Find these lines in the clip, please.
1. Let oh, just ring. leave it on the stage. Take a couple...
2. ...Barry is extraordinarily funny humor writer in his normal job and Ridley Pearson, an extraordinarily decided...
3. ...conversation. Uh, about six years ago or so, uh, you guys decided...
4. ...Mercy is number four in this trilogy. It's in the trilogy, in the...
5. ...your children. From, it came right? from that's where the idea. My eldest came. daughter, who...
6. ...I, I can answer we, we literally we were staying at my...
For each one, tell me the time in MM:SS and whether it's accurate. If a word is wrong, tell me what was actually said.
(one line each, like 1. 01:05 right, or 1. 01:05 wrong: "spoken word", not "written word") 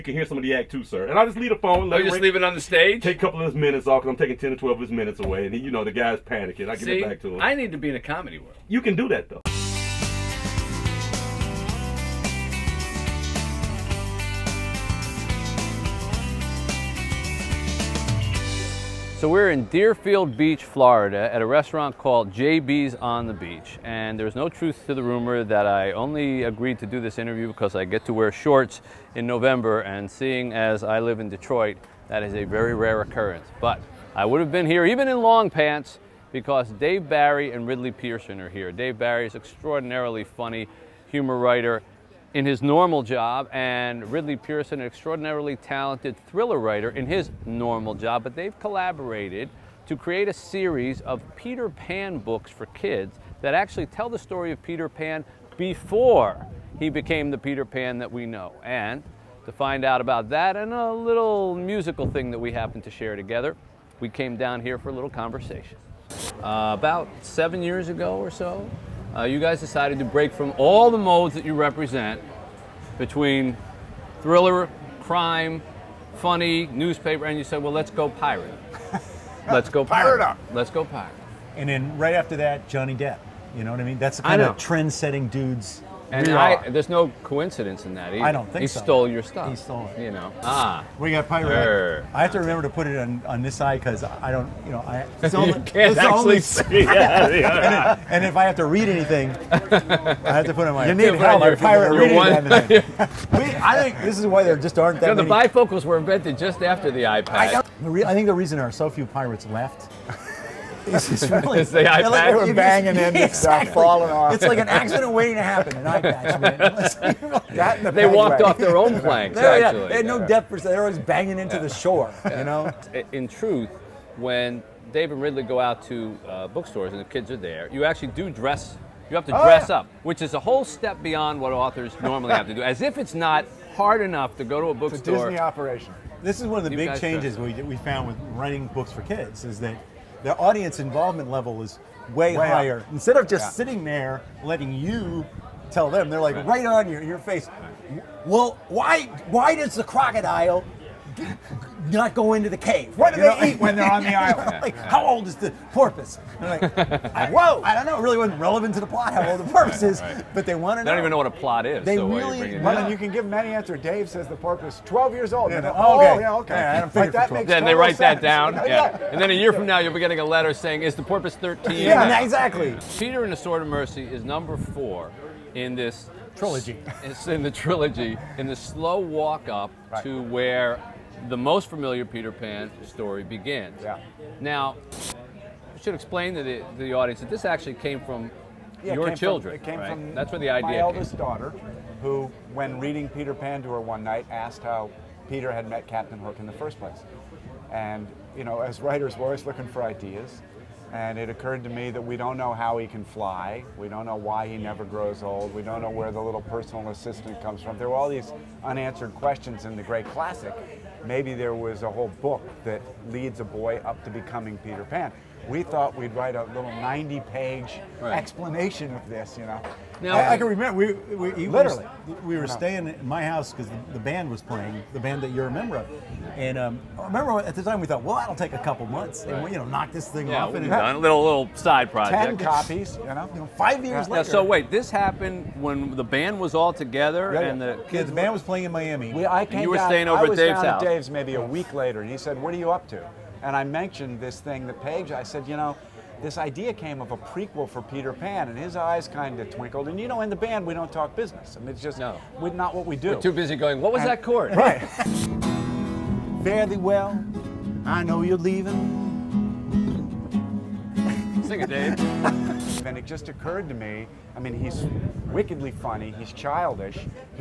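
1. 00:01 right
2. 00:38 wrong: "talented", not "decided"
3. 01:05 wrong: "seven", not "six"
4. 02:53 right
5. 03:08 right
6. 03:40 wrong: "remember", not "answer".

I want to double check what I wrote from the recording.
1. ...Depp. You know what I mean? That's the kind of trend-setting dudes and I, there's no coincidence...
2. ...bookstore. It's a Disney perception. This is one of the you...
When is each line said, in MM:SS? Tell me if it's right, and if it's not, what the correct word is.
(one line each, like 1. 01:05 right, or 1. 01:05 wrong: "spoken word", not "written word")
1. 01:22 right
2. 02:14 wrong: "operation", not "perception".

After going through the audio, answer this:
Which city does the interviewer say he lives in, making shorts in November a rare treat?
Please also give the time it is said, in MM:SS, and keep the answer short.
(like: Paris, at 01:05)
Detroit, at 00:31.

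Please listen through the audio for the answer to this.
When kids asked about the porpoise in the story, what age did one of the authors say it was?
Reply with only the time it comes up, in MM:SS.
02:44.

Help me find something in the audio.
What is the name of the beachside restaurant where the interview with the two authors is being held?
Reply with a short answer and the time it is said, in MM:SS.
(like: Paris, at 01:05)
JB's on the Beach, at 00:22.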